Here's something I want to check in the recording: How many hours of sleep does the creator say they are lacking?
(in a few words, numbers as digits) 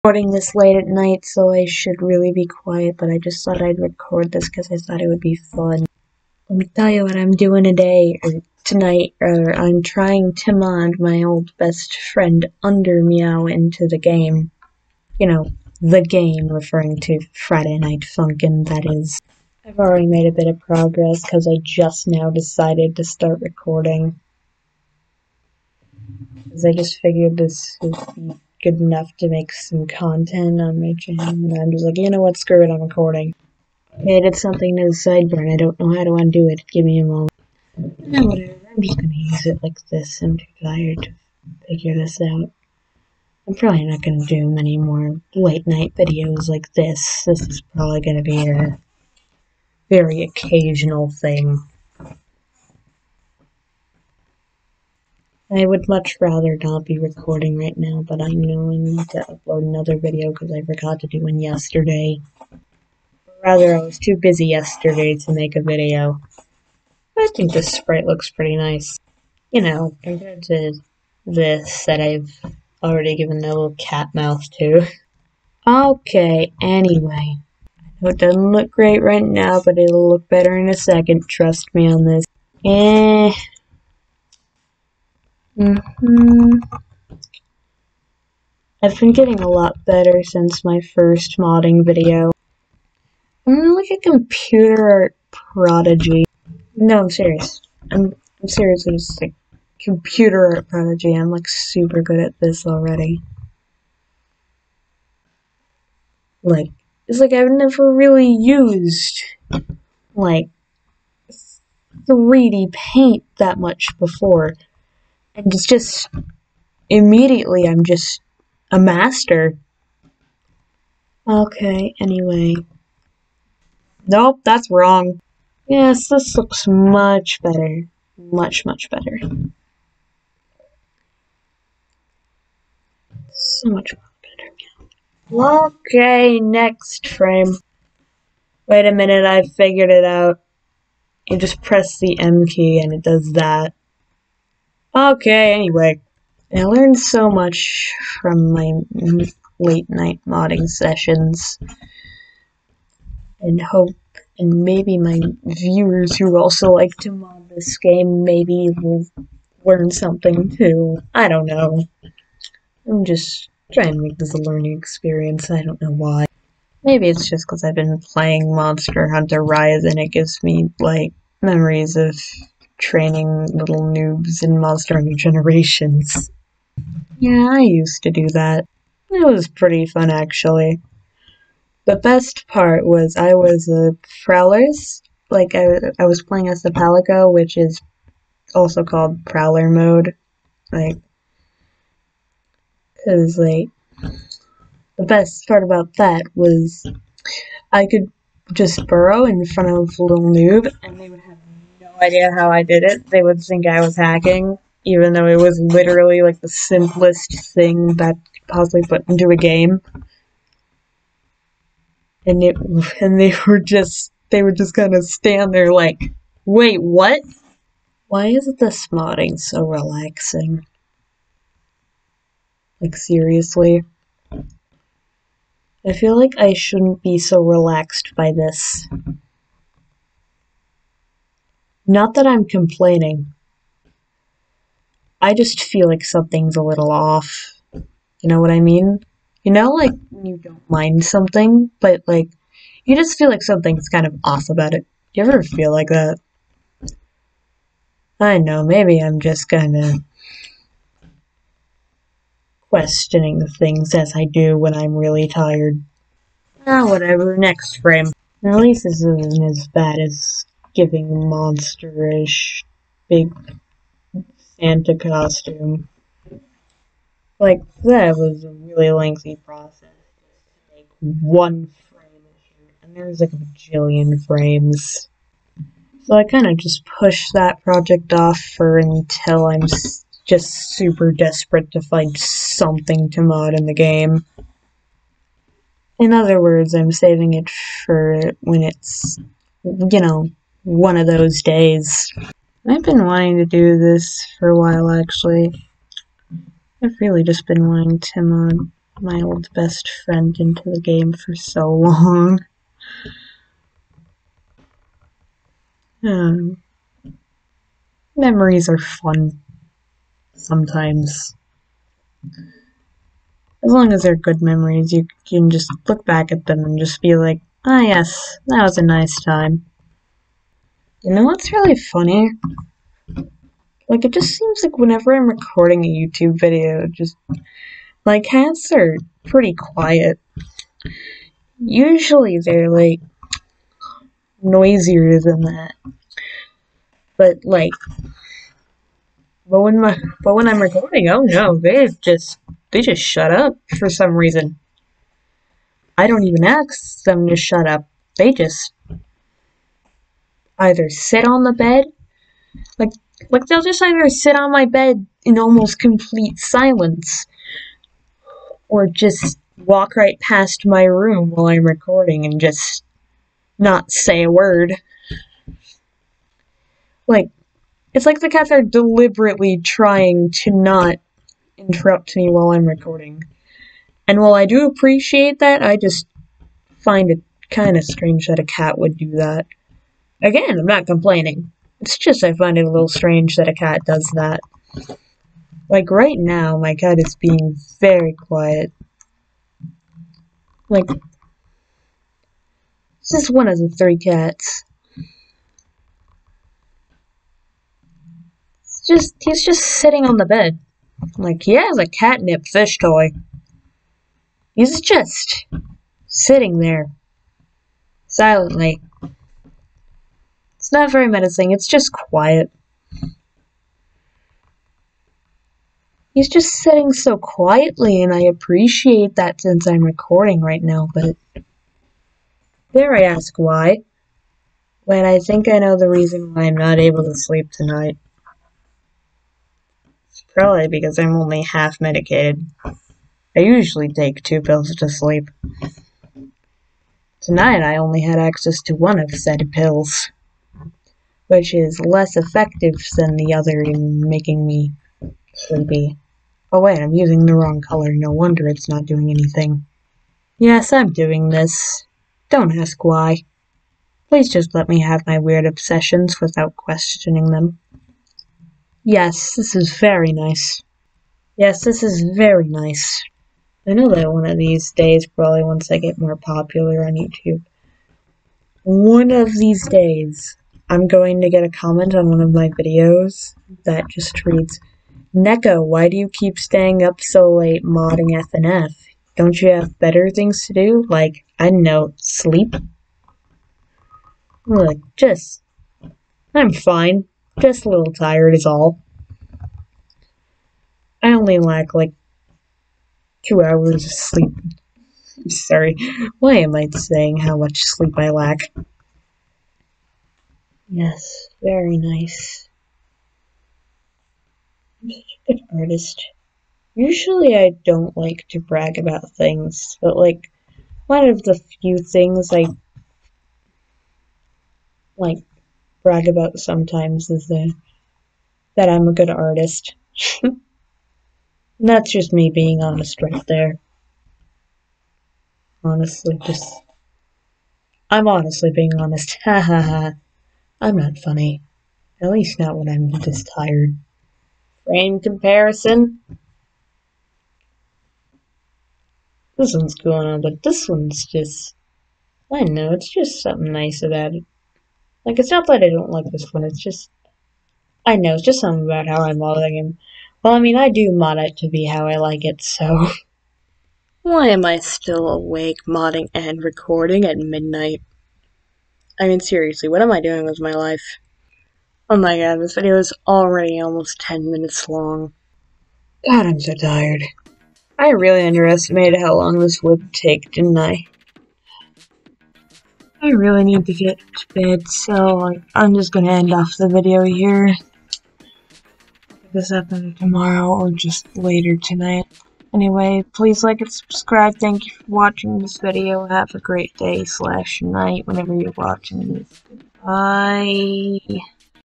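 2.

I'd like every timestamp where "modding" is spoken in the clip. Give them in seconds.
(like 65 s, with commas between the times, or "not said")
91 s, 150 s, 218 s, 477 s, 549 s, 555 s.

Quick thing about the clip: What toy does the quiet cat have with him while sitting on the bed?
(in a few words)
catnip fish toy.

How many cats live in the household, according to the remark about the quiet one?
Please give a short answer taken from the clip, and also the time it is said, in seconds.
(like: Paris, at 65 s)
3, at 393 s.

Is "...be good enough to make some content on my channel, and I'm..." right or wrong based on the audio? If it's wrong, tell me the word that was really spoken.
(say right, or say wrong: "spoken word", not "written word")
right.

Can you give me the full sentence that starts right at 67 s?
I think this sprite looks pretty nice.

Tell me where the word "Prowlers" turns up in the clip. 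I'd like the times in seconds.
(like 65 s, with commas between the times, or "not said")
184 s, 189 s.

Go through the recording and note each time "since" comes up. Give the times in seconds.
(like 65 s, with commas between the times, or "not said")
90 s, 419 s.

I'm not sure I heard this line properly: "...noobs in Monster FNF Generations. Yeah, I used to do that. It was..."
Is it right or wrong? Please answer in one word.
wrong.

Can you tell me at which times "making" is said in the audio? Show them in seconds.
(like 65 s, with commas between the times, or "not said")
444 s.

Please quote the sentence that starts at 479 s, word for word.
Don't you have better things to do?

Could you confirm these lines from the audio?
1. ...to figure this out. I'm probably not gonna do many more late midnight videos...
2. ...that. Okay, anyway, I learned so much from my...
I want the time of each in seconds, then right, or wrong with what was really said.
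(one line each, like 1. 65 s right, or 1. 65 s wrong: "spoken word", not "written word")
1. 41 s wrong: "night", not "midnight"
2. 143 s right.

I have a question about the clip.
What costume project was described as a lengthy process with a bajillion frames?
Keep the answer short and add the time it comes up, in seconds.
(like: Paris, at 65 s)
big Santa costume, at 263 s.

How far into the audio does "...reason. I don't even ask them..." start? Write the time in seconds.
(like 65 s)
344 s.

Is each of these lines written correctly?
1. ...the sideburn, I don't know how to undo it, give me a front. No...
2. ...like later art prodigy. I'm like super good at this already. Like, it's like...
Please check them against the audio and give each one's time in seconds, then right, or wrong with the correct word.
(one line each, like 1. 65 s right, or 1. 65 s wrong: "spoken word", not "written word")
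1. 34 s wrong: "moment", not "front"
2. 99 s wrong: "computer", not "later".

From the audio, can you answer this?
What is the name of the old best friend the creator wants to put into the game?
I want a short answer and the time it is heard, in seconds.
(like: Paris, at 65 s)
Under Meow, at 12 s.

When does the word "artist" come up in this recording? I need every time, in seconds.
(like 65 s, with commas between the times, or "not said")
505 s, 519 s.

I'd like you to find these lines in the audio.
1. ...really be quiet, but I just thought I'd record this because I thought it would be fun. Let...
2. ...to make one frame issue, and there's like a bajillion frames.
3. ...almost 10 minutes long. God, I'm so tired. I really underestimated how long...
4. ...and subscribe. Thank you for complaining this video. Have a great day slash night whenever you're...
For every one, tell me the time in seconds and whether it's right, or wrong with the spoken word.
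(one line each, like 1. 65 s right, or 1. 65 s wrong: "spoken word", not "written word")
1. 2 s right
2. 269 s right
3. 563 s right
4. 583 s wrong: "watching", not "complaining".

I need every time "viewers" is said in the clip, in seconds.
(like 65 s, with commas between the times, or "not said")
155 s.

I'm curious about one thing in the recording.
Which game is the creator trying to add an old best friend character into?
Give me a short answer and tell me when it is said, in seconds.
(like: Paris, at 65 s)
Friday Night Funkin', at 17 s.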